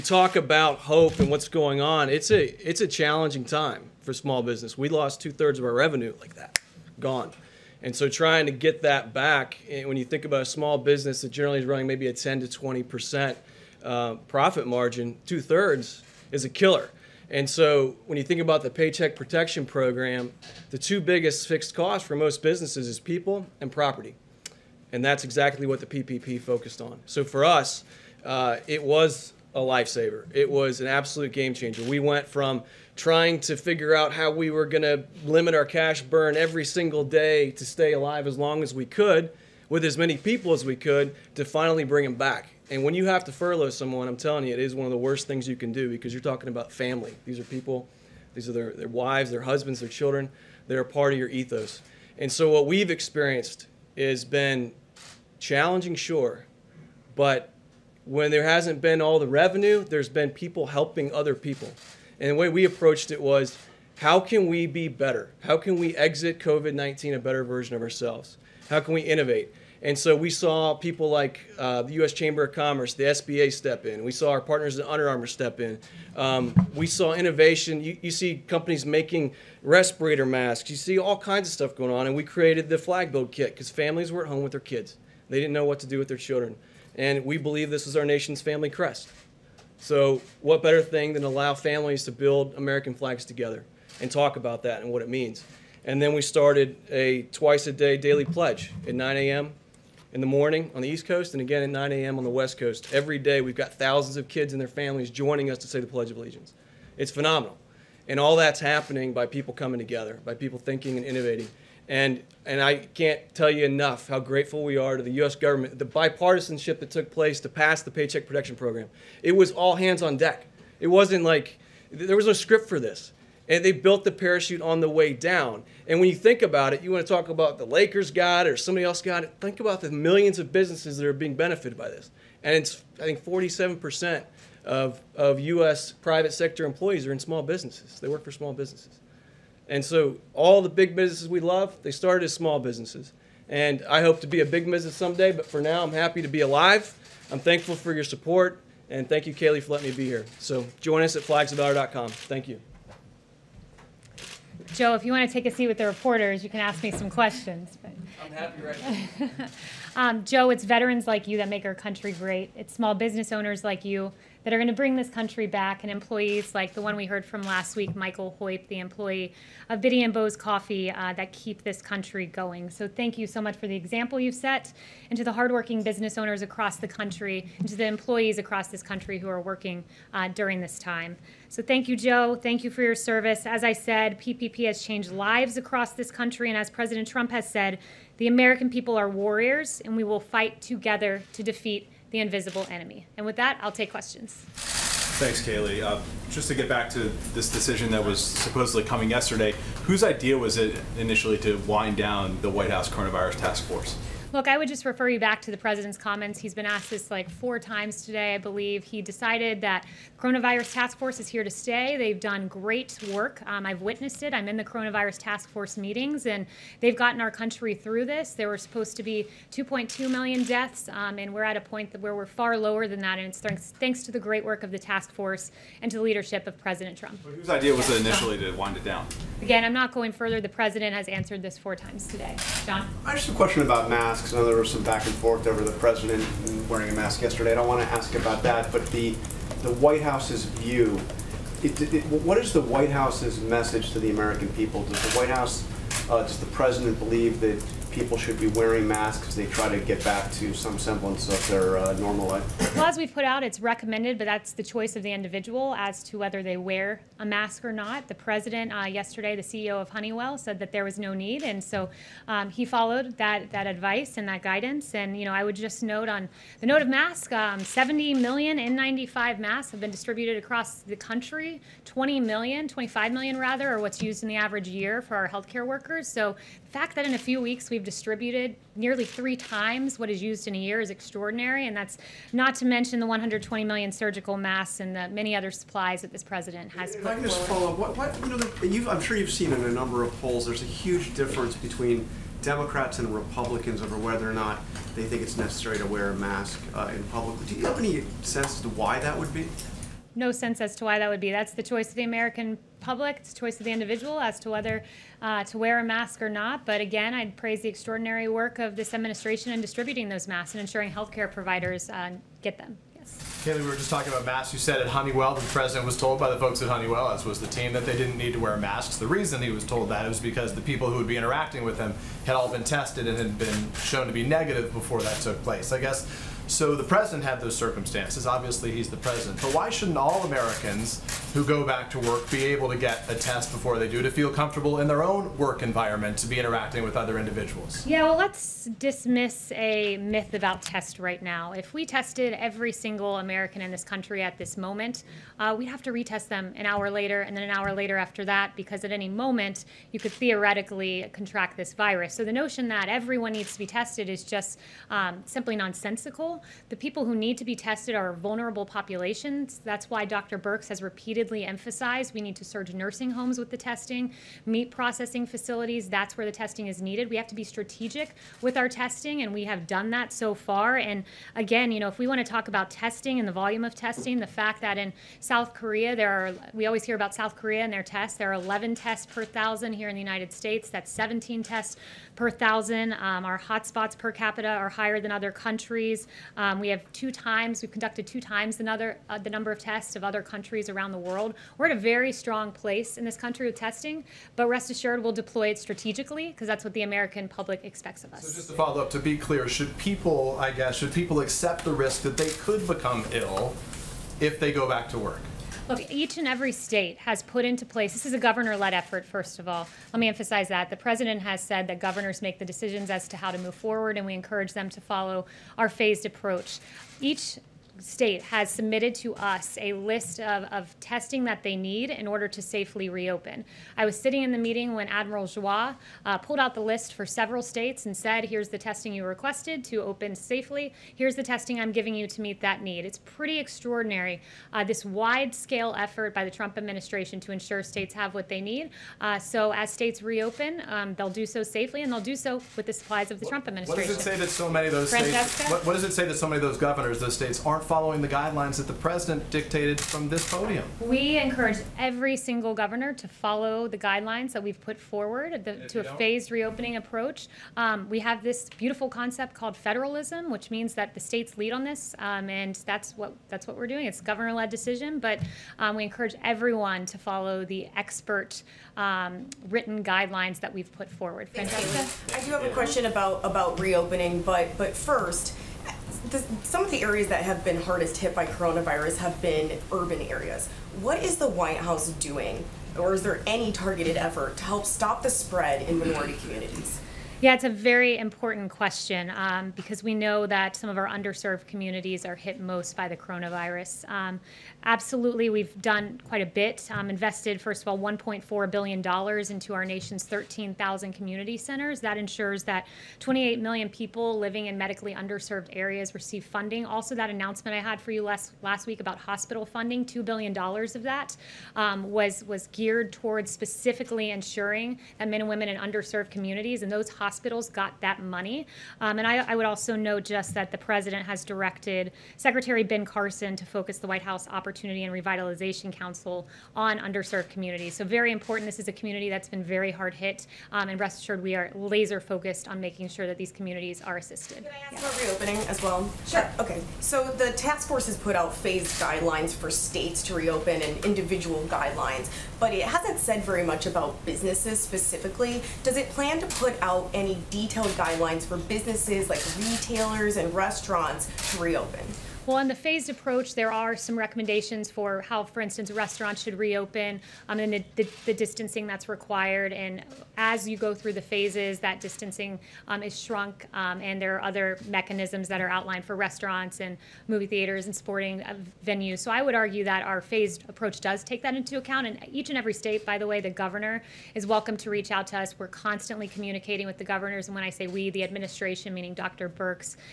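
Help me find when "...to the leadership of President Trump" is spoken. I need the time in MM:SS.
03:45.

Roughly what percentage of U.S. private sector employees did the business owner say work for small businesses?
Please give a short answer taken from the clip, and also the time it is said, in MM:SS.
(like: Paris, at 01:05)
47%, at 02:13.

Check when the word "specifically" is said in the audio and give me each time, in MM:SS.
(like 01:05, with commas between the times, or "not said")
08:33, 09:04.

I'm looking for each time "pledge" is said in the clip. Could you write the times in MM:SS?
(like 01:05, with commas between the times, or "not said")
01:38, 01:45.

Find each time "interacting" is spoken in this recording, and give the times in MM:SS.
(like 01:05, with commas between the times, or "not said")
05:21, 05:36.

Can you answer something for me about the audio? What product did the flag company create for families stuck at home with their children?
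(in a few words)
flag build kit.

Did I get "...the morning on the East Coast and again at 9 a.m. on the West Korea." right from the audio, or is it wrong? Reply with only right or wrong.
wrong.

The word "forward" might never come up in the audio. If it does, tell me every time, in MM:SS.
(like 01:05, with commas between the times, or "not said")
06:53, 07:34, 07:50.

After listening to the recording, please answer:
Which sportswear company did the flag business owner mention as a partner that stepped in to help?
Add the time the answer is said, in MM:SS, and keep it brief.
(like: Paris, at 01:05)
Under Armour, at 01:14.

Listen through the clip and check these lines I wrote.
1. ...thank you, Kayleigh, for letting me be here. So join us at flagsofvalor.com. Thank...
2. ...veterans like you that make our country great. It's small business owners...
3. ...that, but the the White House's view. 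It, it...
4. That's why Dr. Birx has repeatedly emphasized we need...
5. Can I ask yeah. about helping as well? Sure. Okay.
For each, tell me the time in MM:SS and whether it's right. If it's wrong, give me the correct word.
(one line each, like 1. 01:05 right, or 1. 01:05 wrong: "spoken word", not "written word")
1. 02:29 right
2. 02:40 right
3. 03:58 right
4. 05:59 right
5. 08:54 wrong: "reopening", not "helping".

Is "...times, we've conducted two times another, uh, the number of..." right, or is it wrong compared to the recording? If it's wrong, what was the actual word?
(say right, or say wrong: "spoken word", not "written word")
right.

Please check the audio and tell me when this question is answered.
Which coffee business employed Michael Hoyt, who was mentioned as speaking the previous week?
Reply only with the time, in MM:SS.
02:49.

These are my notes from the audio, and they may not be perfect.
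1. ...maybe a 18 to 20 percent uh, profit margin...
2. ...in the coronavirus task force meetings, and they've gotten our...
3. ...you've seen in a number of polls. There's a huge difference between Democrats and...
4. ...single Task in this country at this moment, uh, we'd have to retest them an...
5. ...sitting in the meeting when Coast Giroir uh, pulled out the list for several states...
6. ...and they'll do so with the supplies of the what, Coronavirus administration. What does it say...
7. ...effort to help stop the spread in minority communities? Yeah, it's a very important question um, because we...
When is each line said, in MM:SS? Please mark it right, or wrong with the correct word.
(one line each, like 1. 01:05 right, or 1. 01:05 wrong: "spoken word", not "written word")
1. 00:11 wrong: "10", not "18"
2. 03:34 right
3. 04:49 right
4. 05:42 wrong: "American", not "Task"
5. 07:03 wrong: "Admiral", not "Coast"
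6. 07:21 wrong: "Trump", not "Coronavirus"
7. 08:03 right.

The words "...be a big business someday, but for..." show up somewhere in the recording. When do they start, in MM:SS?
02:24.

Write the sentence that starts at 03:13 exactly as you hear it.
And with that, I'll take questions.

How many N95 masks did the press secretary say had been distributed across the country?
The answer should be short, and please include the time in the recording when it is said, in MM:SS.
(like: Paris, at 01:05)
70 million, at 04:27.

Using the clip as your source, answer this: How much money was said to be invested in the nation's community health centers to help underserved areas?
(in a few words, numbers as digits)
$1.4 billion.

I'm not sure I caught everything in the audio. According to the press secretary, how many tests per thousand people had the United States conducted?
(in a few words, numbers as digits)
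17.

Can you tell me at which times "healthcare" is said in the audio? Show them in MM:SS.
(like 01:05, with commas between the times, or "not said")
04:35, 05:10.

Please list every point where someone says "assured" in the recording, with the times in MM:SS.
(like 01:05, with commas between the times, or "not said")
06:34, 08:50.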